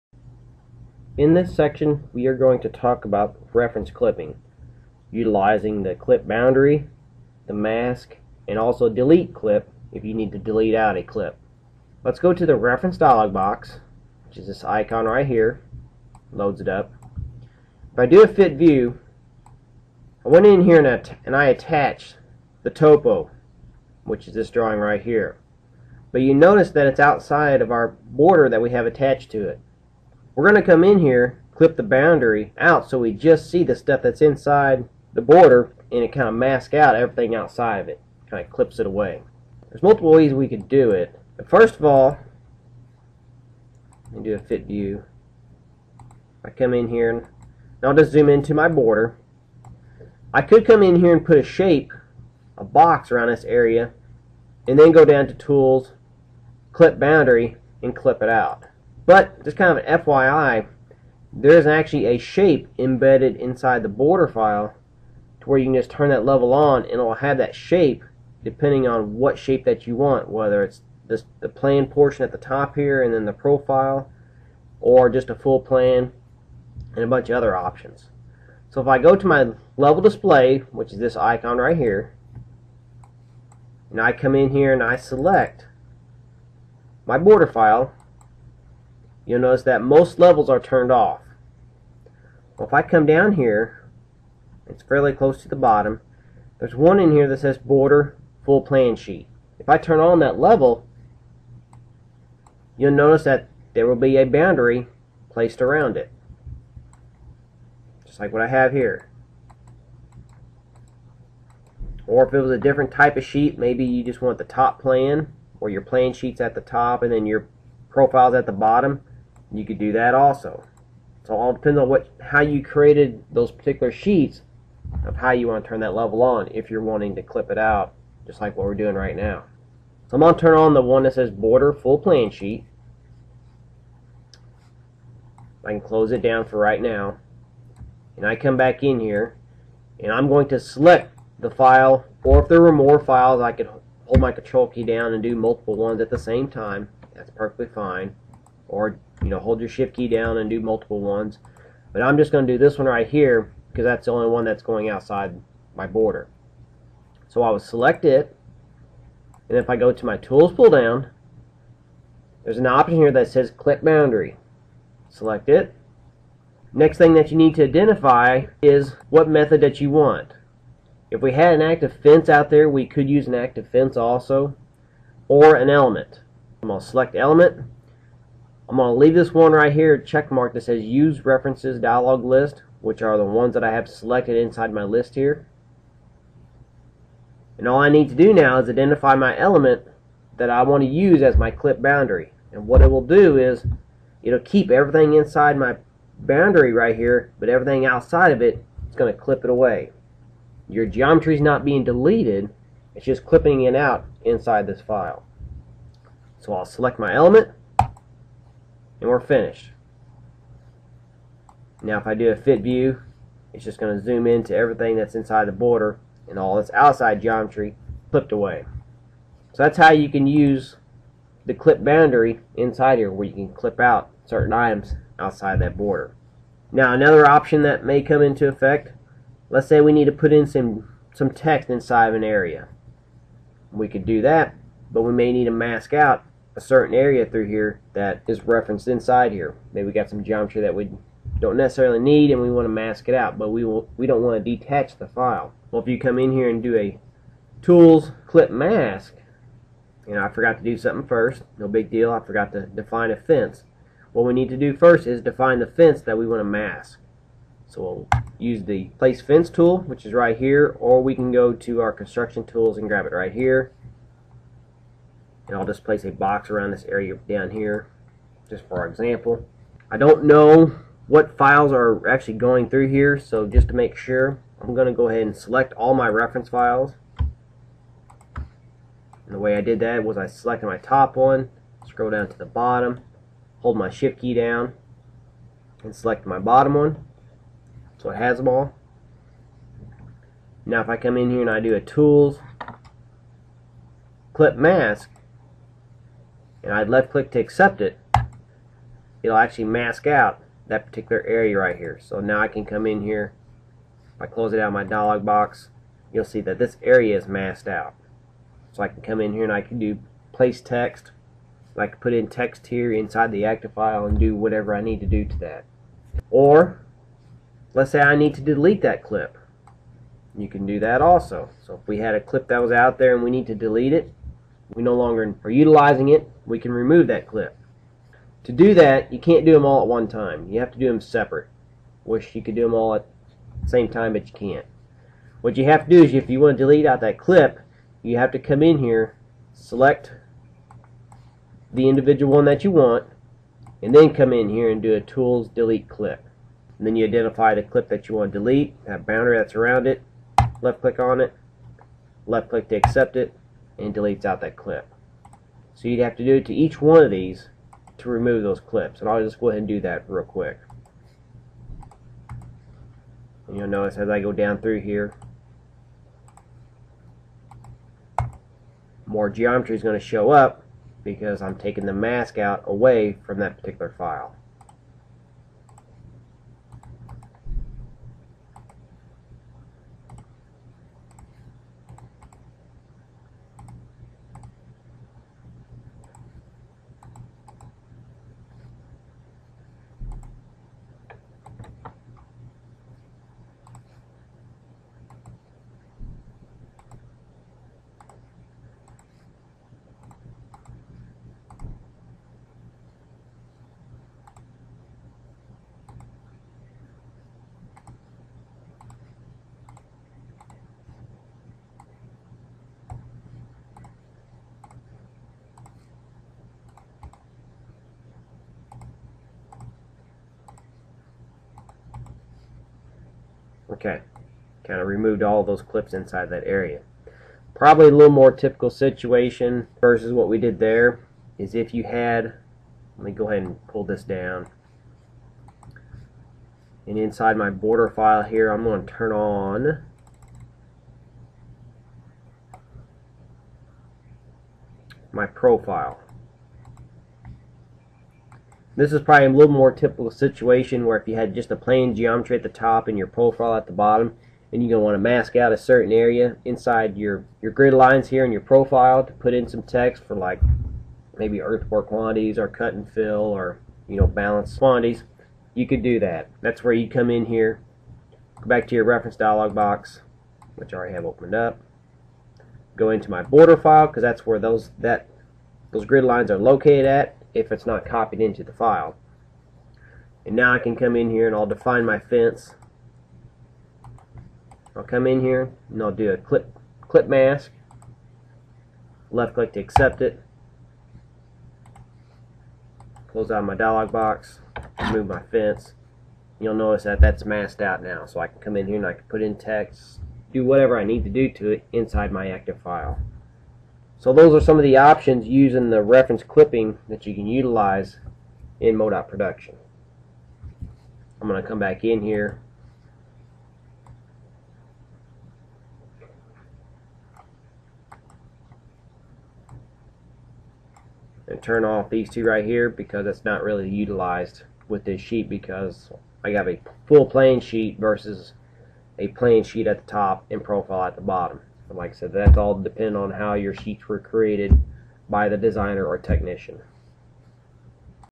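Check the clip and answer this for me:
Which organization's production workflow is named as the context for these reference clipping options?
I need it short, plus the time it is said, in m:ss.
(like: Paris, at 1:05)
MoDOT, at 8:28.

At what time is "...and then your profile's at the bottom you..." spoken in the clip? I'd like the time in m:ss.
1:57.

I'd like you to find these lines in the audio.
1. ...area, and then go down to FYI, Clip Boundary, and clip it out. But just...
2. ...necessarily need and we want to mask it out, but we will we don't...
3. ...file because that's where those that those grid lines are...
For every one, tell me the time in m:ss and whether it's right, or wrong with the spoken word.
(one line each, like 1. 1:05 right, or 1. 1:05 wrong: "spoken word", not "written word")
1. 0:53 wrong: "Tools", not "FYI"
2. 4:01 right
3. 7:53 right.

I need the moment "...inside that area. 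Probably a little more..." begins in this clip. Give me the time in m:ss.
7:05.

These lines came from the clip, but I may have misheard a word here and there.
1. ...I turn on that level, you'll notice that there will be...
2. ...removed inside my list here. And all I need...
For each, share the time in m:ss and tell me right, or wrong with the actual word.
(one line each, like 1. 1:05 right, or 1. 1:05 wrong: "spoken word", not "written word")
1. 1:39 right
2. 3:03 wrong: "selected", not "removed".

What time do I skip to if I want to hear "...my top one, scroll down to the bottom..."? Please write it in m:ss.
4:40.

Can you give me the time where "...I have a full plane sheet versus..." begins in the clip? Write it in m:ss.
8:46.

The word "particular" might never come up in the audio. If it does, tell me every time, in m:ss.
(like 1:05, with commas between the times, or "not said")
2:03, 5:00, 6:13.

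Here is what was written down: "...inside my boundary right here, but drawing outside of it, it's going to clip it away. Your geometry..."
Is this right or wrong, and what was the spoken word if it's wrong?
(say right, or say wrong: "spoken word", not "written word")
wrong: "everything", not "drawing".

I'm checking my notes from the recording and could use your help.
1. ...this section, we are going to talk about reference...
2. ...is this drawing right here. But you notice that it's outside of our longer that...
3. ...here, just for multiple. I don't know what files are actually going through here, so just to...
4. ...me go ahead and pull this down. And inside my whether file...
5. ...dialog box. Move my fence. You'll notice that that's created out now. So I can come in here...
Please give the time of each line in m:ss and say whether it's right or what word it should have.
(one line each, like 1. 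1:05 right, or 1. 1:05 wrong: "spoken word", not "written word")
1. 0:01 right
2. 0:24 wrong: "border", not "longer"
3. 4:27 wrong: "example", not "multiple"
4. 7:13 wrong: "border", not "whether"
5. 8:13 wrong: "masked", not "created".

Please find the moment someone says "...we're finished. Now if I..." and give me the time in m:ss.
3:29.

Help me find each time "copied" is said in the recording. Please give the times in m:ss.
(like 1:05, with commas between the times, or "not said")
7:57.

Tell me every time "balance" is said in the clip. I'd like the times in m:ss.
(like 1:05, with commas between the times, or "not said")
7:44.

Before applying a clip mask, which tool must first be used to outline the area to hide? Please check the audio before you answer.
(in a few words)
place fence.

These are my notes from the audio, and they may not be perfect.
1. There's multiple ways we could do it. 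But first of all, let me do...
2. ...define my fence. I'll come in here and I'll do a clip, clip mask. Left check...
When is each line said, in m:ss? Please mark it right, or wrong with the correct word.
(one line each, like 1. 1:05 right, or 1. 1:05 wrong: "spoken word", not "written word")
1. 0:39 right
2. 8:01 wrong: "click", not "check".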